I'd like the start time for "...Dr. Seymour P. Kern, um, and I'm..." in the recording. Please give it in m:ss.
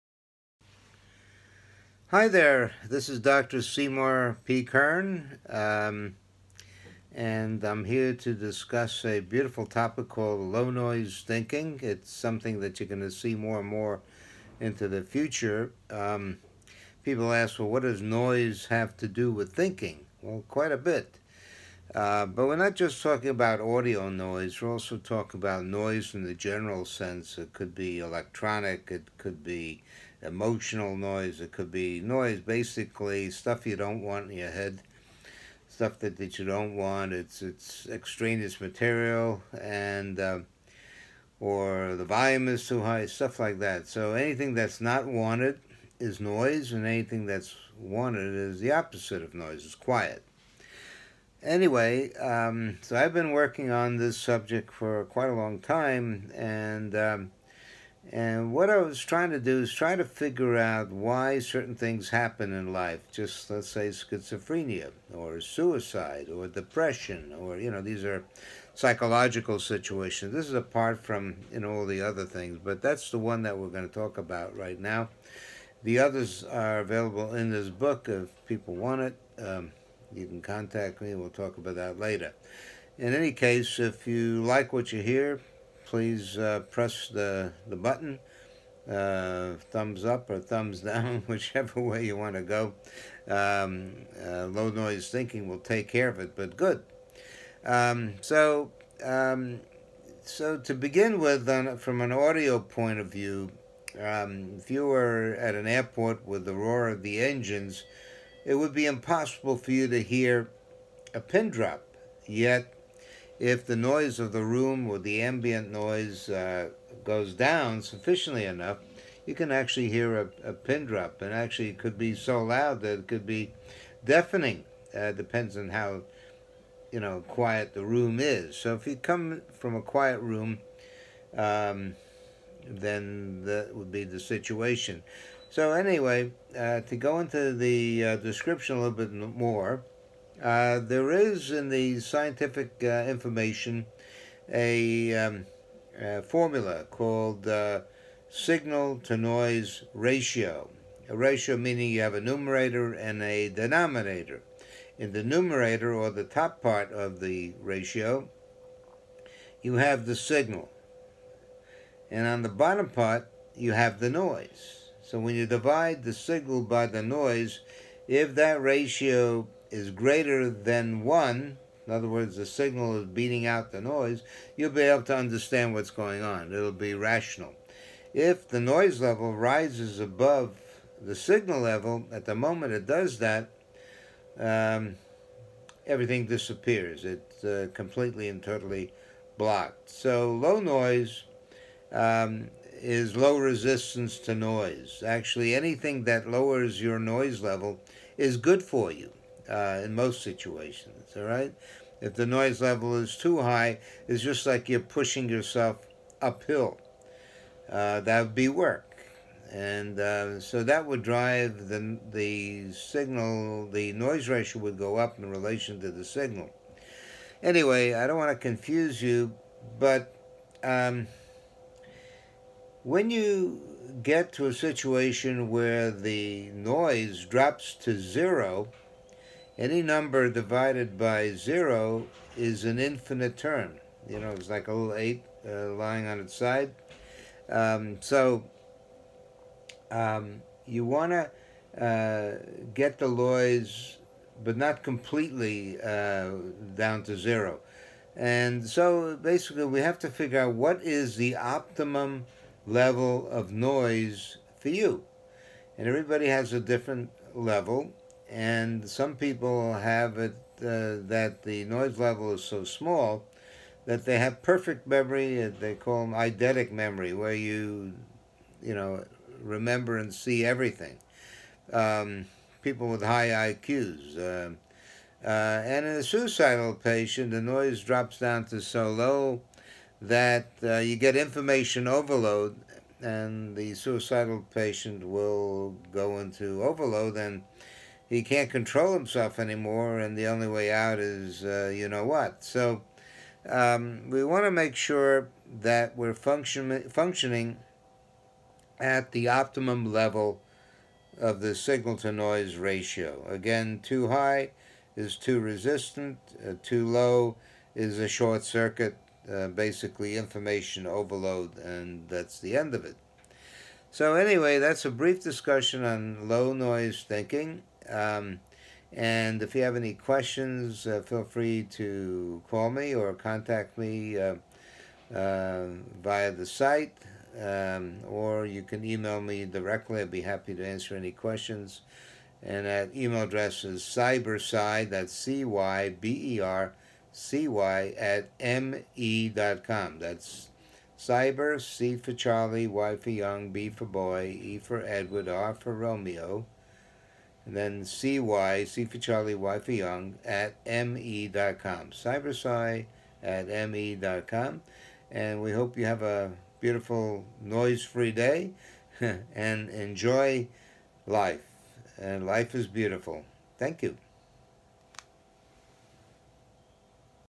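0:03.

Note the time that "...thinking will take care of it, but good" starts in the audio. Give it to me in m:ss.
1:35.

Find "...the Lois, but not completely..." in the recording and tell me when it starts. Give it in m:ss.
4:02.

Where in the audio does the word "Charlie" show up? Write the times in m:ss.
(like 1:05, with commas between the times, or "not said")
5:42, 5:48.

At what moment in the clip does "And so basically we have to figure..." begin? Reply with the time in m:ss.
4:08.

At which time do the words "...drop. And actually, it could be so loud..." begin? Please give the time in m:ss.
2:00.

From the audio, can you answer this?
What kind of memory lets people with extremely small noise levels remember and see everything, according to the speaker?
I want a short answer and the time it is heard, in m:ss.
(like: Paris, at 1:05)
eidetic memory, at 4:26.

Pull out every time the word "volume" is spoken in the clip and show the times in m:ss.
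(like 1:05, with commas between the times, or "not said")
0:42.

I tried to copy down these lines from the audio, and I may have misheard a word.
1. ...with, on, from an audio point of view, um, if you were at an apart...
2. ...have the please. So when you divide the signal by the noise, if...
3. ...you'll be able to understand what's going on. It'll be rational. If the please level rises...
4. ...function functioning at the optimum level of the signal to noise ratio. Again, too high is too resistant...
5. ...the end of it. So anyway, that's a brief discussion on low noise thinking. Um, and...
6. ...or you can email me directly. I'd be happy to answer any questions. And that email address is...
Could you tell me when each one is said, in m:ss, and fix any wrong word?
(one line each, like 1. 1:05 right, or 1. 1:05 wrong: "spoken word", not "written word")
1. 1:41 wrong: "airport", not "apart"
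2. 2:43 wrong: "noise", not "please"
3. 2:54 wrong: "noise", not "please"
4. 4:56 right
5. 5:12 right
6. 5:28 right.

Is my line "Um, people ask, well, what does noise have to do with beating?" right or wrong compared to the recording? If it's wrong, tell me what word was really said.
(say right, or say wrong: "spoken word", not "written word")
wrong: "thinking", not "beating".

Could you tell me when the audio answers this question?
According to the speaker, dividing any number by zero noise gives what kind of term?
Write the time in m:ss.
3:52.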